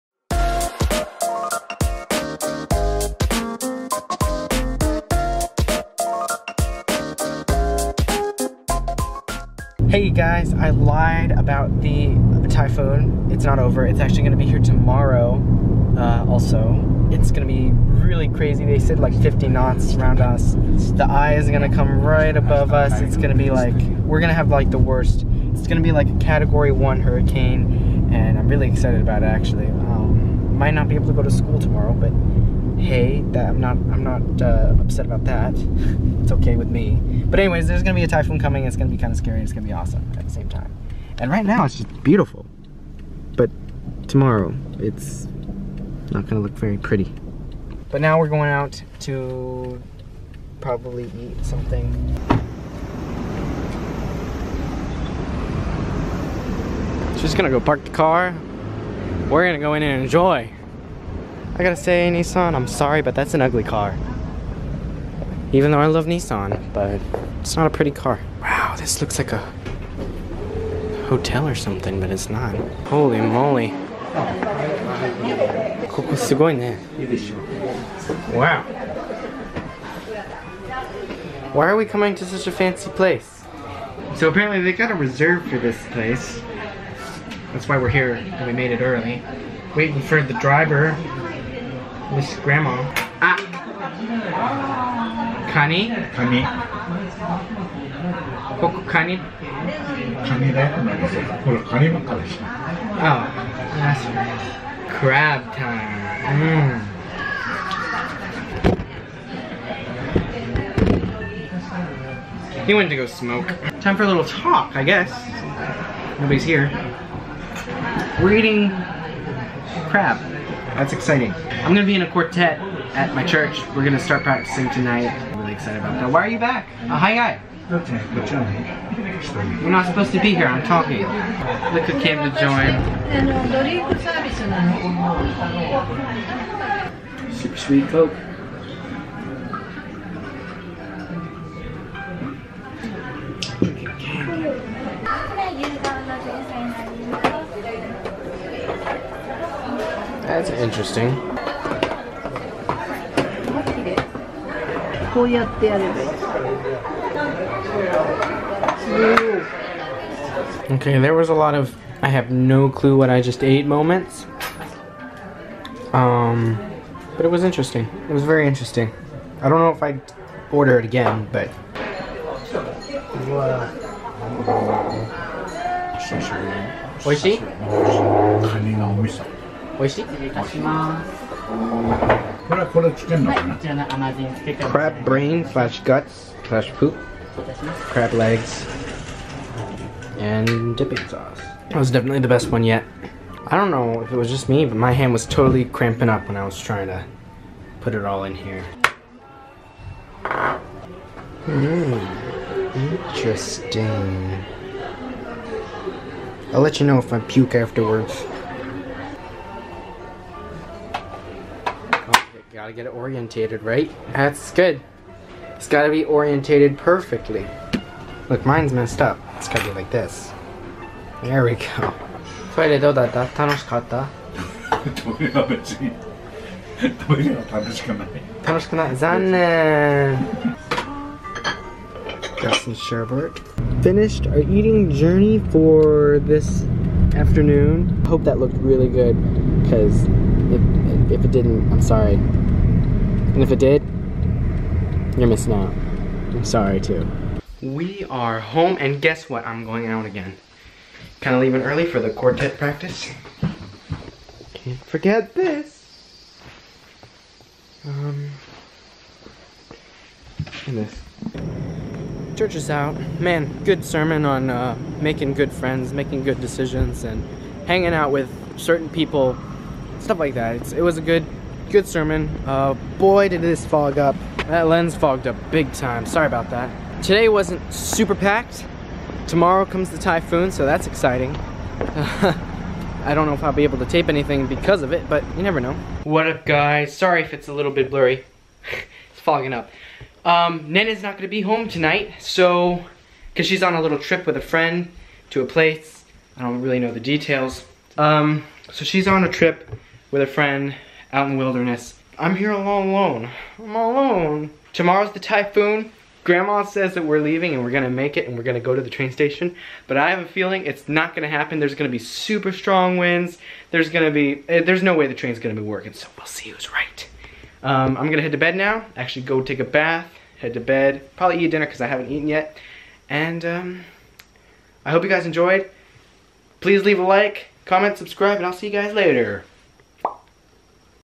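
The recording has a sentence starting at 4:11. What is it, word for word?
Kind of leaving early for the quartet practice.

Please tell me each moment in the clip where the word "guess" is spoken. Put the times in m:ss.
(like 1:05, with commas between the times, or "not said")
1:54, 4:09.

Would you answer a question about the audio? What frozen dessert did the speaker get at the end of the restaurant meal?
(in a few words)
Sherbet.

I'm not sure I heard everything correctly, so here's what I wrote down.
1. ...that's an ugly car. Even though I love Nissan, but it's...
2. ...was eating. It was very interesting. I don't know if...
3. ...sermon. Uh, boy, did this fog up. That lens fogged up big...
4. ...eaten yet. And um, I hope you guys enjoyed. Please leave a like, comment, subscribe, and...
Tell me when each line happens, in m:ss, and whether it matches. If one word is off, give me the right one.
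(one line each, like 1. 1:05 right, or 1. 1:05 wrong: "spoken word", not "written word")
1. 1:03 right
2. 2:47 wrong: "interesting", not "eating"
3. 4:31 right
4. 5:22 right.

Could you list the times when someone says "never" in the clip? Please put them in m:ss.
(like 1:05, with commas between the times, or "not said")
4:45.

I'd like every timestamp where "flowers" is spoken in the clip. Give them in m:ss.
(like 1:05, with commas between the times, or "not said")
not said.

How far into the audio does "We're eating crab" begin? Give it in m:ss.
1:58.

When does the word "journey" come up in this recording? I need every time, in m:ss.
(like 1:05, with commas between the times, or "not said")
3:54.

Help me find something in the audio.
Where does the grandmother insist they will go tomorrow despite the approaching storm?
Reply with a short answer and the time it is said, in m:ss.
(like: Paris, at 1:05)
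The train station, at 5:08.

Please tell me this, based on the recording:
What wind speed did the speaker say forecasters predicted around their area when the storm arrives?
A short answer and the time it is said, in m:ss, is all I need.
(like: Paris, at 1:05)
50 knots, at 0:19.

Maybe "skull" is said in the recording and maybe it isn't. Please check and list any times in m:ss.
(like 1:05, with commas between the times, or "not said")
not said.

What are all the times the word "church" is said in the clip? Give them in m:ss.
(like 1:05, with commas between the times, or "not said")
2:03, 4:22.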